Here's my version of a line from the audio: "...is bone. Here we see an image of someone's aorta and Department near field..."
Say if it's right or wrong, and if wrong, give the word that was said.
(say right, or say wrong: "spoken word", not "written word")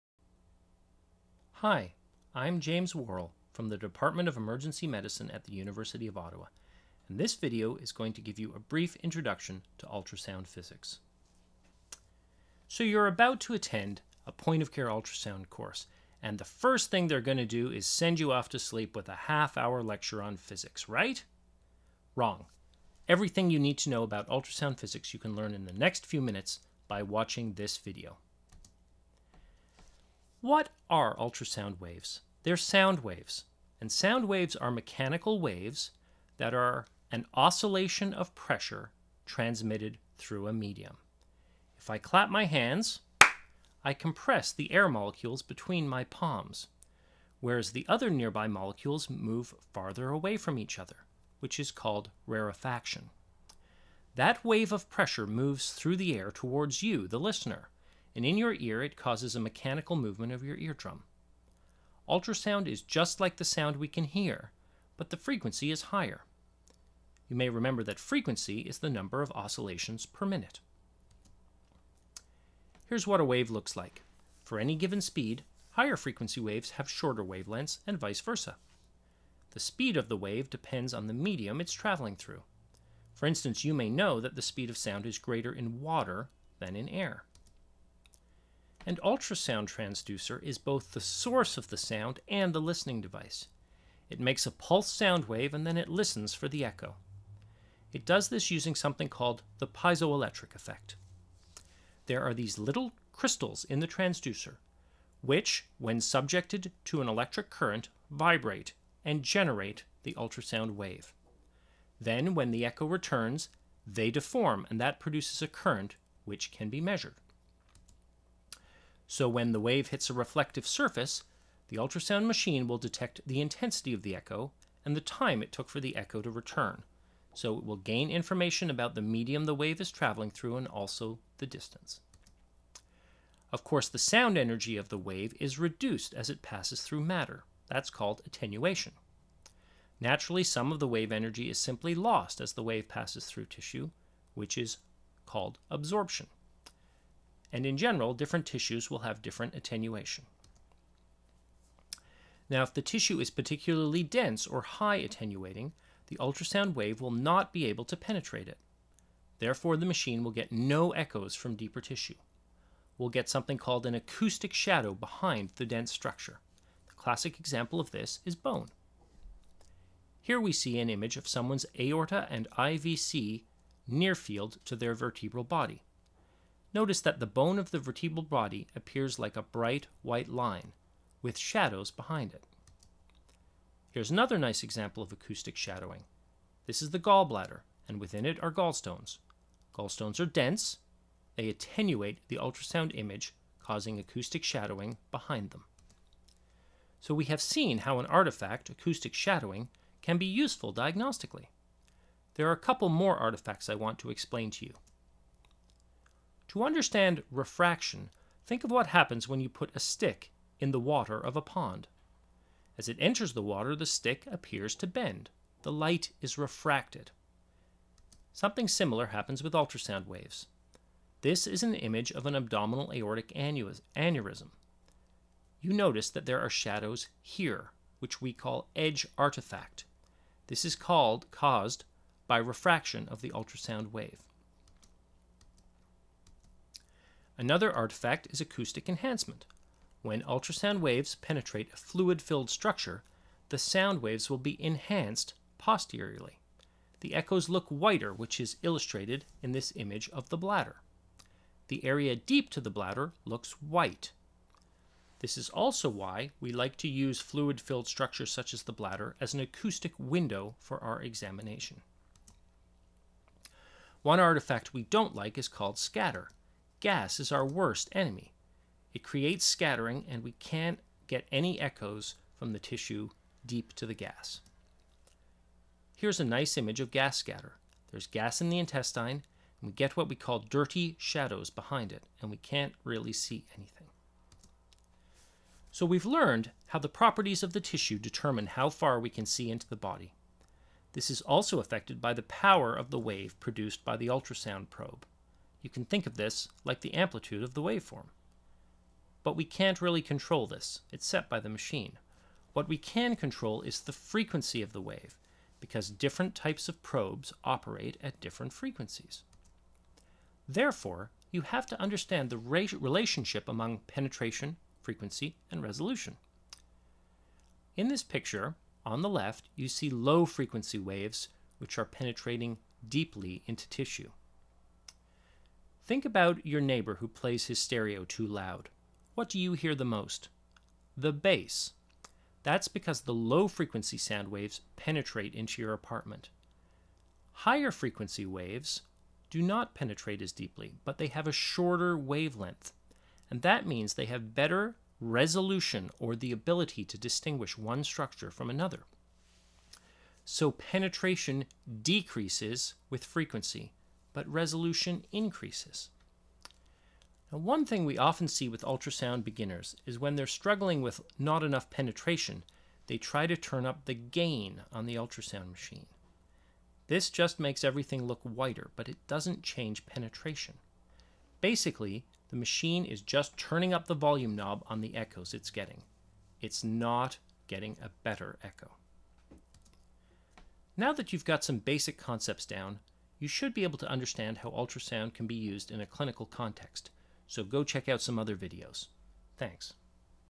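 wrong: "IVC", not "Department".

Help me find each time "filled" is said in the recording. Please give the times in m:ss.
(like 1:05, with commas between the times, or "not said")
4:02, 4:17.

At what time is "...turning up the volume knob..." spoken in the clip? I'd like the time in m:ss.
6:13.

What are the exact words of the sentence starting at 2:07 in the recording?
So it will gain information about the medium the wave is traveling through and also the distance.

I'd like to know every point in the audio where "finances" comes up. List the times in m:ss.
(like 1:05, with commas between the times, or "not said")
not said.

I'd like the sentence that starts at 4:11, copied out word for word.
The area deep to the bladder looks white.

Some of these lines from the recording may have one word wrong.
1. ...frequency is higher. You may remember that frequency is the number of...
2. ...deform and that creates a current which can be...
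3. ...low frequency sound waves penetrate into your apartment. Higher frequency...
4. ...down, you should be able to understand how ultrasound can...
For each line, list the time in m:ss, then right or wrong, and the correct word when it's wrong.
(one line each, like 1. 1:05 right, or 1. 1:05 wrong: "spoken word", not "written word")
1. 1:05 right
2. 1:54 wrong: "produces", not "creates"
3. 5:33 right
4. 6:22 right.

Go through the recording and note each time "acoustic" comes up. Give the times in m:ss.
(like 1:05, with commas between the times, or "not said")
2:43, 3:05, 3:13, 3:18, 3:58, 4:19.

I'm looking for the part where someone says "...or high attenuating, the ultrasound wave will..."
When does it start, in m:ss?
2:34.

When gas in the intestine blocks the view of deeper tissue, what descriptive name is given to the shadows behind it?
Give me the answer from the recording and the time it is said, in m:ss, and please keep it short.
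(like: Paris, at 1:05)
Dirty shadows, at 4:40.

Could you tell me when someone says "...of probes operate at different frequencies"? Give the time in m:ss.
5:06.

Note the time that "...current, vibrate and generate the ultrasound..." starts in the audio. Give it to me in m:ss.
1:47.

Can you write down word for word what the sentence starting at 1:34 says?
It makes a pulse sound wave and then it listens for the echo.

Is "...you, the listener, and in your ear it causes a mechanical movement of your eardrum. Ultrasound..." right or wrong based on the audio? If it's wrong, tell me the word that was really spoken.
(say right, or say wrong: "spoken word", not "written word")
right.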